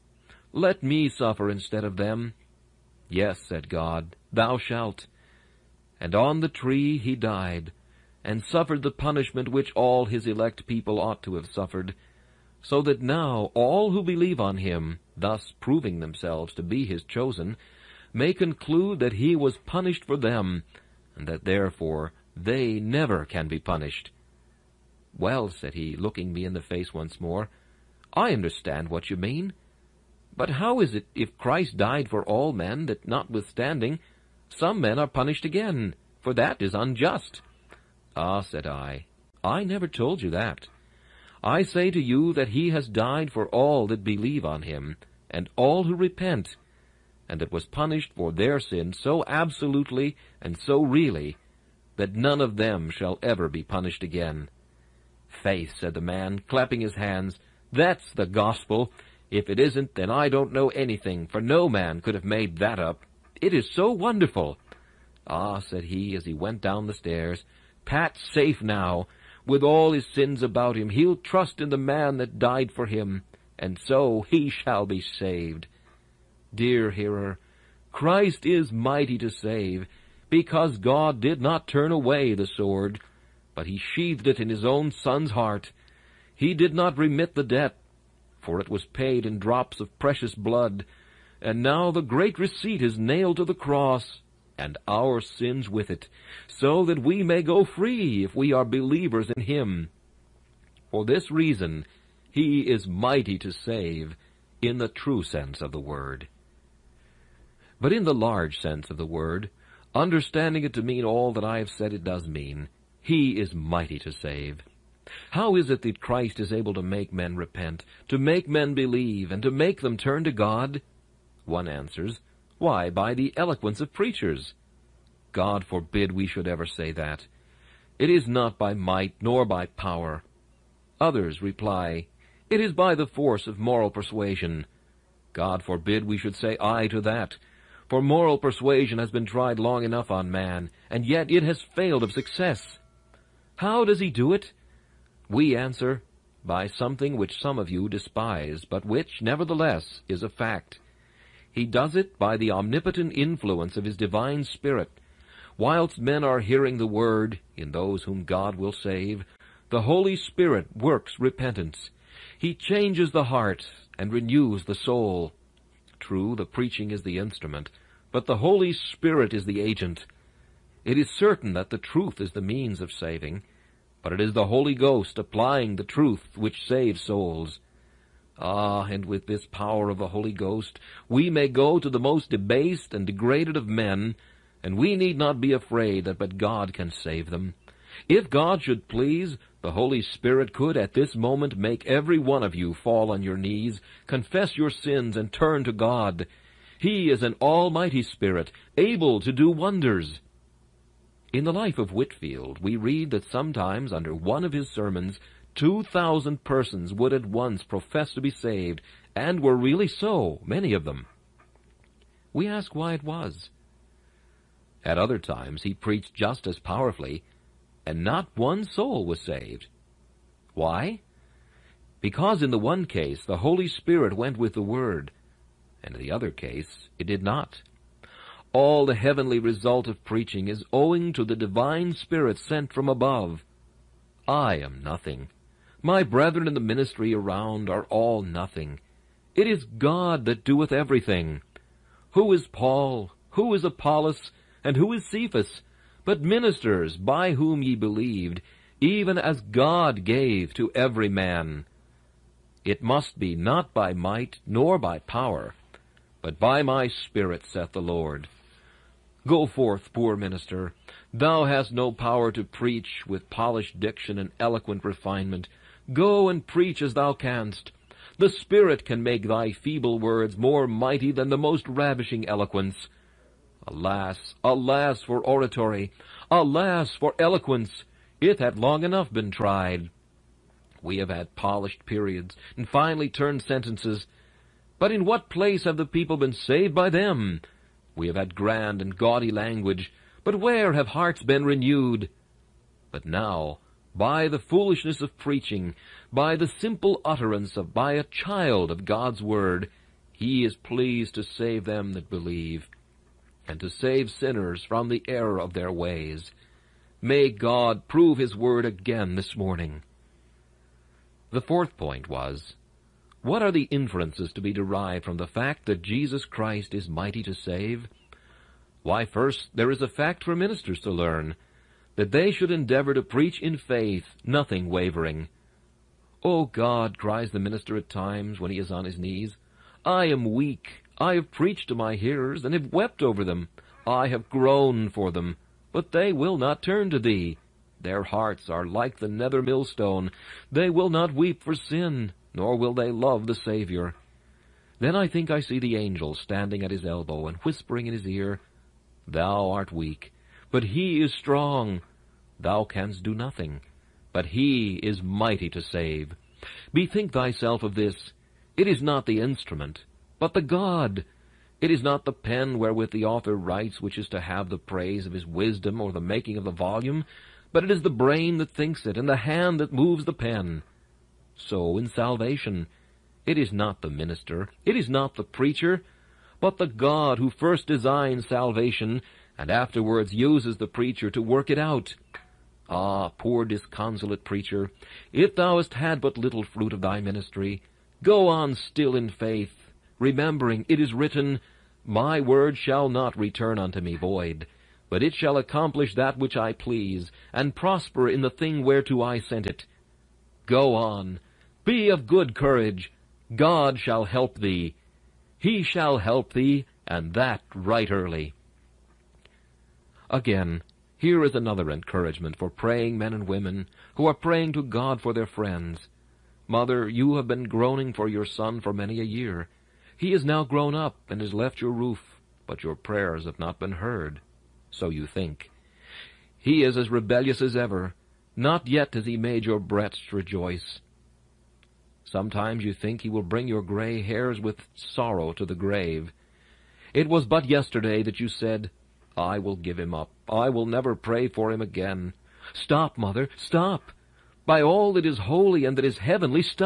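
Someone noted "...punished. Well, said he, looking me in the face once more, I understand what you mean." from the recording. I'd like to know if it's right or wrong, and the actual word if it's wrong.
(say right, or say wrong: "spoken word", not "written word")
right.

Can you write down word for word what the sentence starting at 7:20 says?
I will never pray for him again.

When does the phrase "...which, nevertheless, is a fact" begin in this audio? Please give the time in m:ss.
2:28.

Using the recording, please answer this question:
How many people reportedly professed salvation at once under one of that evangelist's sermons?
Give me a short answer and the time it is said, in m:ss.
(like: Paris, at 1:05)
2000, at 3:25.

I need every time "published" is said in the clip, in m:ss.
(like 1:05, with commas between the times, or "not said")
not said.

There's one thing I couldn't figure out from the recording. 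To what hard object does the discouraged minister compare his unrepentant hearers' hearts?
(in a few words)
the nether millstone.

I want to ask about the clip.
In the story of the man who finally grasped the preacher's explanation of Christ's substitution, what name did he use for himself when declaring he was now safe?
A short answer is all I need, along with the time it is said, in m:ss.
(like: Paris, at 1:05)
Pat, at 1:07.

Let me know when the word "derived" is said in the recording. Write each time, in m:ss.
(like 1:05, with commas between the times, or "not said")
5:14.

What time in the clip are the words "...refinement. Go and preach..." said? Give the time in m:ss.
4:24.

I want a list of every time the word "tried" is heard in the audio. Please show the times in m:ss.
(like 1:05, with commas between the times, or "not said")
2:19, 4:39.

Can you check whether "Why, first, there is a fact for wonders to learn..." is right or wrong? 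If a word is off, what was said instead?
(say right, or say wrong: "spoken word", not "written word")
wrong: "ministers", not "wonders".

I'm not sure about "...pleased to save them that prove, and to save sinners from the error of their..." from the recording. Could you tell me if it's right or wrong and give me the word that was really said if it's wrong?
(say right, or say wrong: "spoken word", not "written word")
wrong: "believe", not "prove".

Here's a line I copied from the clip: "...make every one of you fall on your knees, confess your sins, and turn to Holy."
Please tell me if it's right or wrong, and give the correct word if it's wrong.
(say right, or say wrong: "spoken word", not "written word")
wrong: "God", not "Holy".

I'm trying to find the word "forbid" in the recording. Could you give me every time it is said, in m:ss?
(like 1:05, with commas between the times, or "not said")
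2:05, 2:15.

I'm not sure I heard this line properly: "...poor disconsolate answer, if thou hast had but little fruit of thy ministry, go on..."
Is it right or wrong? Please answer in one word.
wrong.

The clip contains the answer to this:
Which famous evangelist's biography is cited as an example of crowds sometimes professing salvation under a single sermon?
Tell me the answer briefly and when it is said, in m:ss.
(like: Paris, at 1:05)
Whitfield, at 3:21.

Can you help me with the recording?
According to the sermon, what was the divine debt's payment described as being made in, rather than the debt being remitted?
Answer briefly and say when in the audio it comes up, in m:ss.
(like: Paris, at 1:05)
drops of precious blood, at 1:29.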